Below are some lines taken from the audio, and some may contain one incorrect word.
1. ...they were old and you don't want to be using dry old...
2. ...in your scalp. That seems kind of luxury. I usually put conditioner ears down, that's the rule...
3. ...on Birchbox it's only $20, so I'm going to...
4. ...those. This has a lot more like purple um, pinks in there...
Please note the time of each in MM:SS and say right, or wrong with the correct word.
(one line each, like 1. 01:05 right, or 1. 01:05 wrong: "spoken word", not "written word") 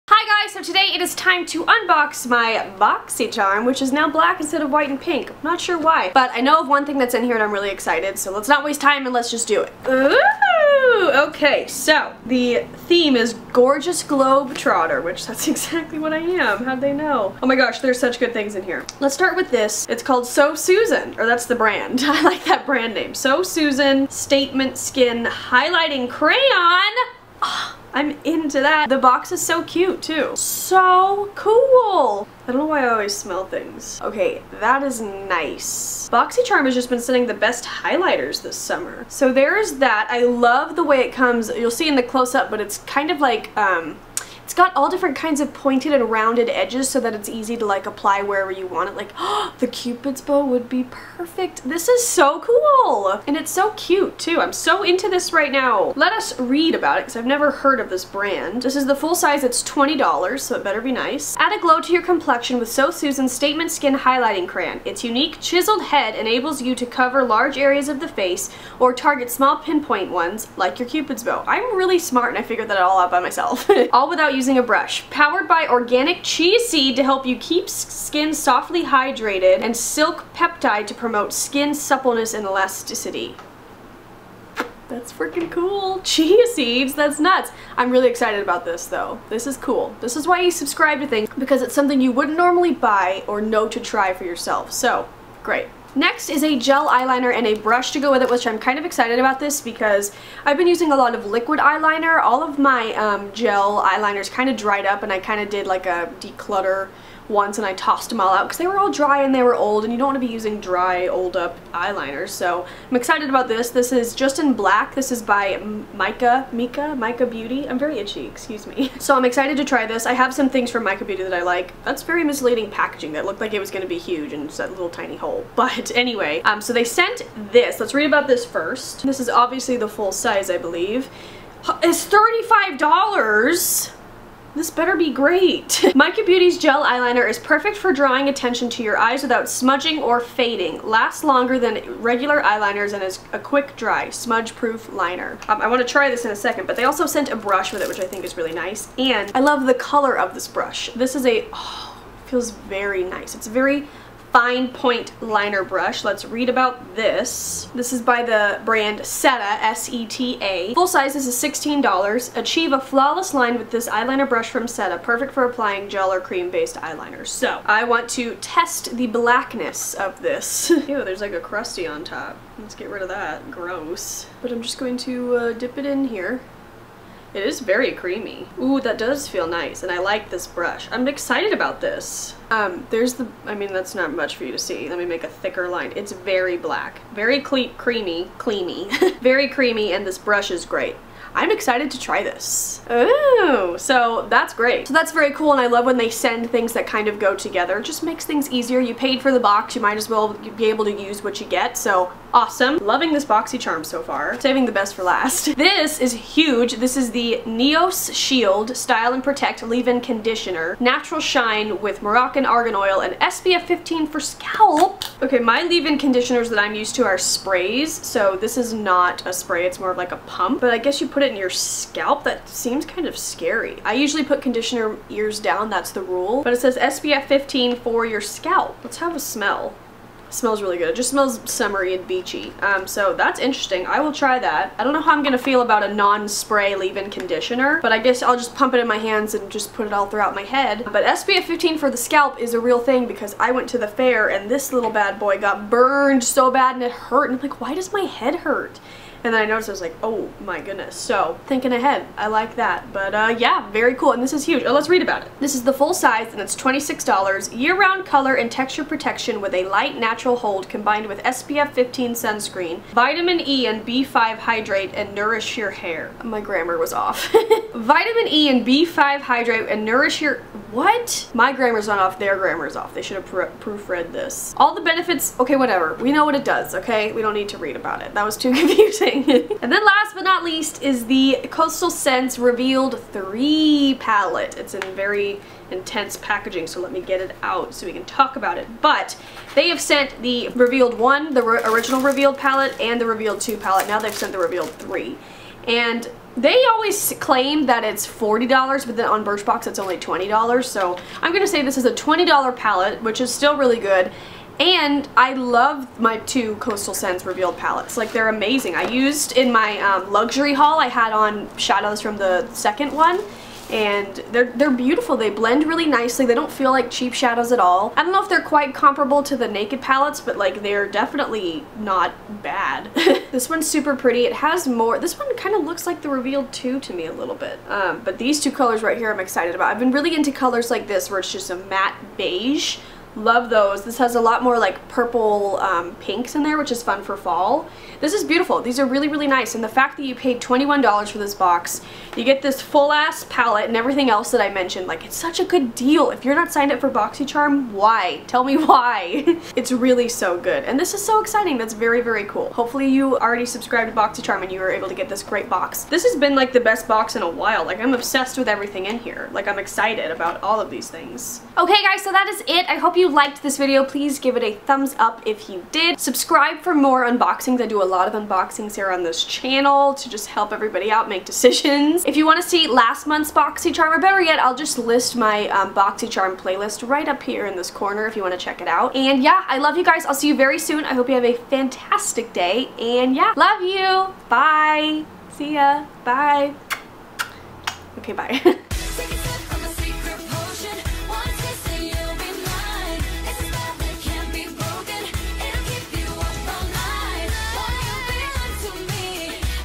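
1. 01:49 right
2. 03:41 wrong: "scary", not "luxury"
3. 04:59 right
4. 05:33 right.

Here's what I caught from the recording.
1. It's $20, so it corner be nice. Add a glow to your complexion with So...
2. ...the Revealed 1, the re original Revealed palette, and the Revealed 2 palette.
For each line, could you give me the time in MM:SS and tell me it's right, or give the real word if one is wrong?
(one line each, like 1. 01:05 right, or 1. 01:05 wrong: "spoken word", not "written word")
1. 00:59 wrong: "better", not "corner"
2. 04:50 right.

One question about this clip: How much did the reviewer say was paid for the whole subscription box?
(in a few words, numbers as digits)
$21.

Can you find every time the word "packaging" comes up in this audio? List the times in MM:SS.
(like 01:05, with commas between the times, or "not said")
02:02, 04:46.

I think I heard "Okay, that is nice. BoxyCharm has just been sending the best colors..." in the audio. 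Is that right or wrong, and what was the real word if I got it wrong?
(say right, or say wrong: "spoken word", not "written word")
wrong: "highlighters", not "colors".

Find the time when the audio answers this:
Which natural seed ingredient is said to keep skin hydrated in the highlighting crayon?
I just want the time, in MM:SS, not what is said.
01:16.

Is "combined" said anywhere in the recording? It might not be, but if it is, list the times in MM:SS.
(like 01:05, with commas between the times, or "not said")
04:20.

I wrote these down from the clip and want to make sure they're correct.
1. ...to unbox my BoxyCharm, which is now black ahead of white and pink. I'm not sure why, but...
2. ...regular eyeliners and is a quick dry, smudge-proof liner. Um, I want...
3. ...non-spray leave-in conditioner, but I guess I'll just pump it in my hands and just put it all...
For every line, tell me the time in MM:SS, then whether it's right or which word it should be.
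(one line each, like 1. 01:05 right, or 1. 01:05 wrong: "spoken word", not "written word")
1. 00:01 wrong: "instead", not "ahead"
2. 02:22 right
3. 03:55 right.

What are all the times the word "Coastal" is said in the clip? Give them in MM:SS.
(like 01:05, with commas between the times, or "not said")
04:41, 05:06.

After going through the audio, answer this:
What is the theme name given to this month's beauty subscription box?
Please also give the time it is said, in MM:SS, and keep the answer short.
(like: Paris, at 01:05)
Gorgeous Globe Trotter, at 00:13.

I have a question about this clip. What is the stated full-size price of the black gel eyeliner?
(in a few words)
$35.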